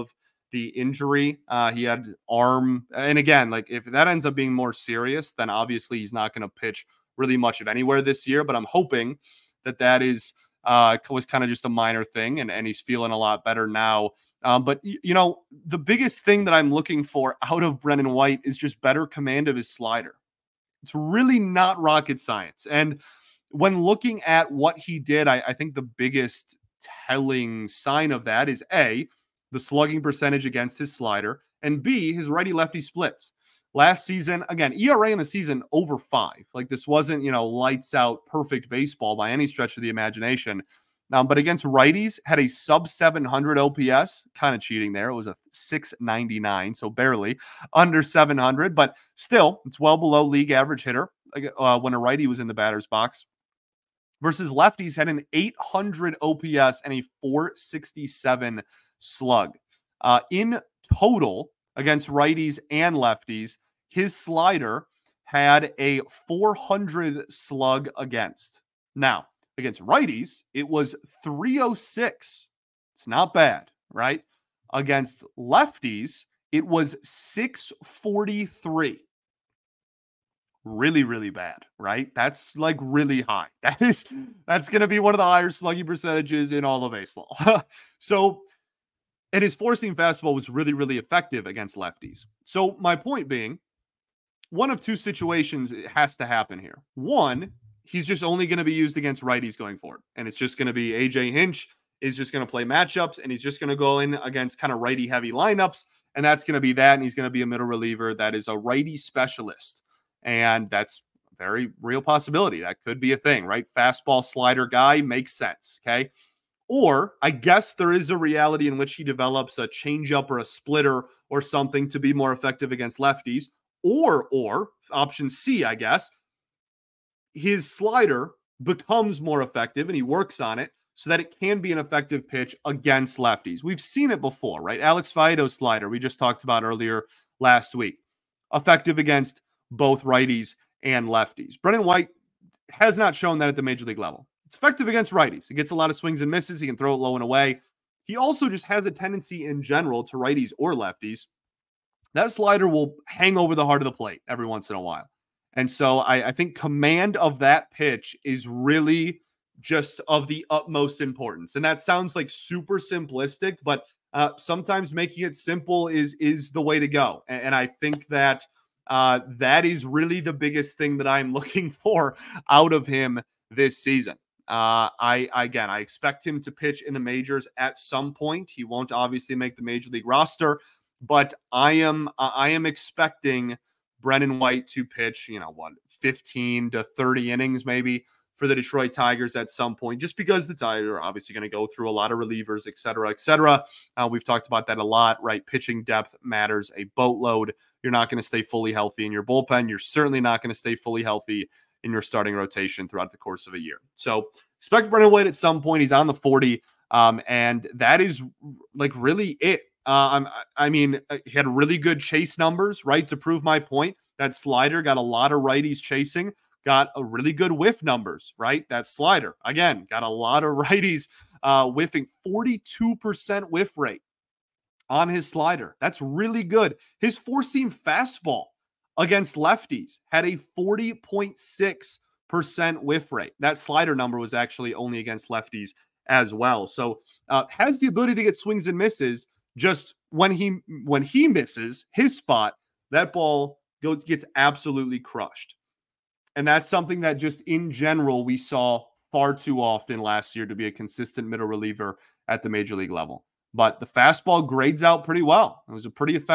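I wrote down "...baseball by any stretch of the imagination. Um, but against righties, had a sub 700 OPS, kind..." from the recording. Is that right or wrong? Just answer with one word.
right.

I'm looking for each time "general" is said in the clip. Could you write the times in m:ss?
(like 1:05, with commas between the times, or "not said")
2:29, 4:07.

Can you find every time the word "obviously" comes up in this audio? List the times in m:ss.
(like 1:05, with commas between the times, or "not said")
0:05, 2:58, 3:11.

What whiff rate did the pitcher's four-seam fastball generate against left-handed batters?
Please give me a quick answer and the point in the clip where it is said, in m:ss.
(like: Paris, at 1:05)
40.6%, at 3:50.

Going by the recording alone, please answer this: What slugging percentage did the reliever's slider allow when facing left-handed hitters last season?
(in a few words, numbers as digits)
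.643.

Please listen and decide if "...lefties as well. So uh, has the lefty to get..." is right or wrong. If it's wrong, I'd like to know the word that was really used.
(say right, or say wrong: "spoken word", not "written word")
wrong: "ability", not "lefty".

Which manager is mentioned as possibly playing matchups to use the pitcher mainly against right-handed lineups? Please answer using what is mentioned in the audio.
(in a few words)
AJ Hinch.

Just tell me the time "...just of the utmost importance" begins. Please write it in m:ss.
2:39.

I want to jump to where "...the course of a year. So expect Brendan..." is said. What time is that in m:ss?
3:23.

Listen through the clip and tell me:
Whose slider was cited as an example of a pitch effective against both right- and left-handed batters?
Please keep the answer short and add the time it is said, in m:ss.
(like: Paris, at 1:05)
Alex Faedo, at 2:14.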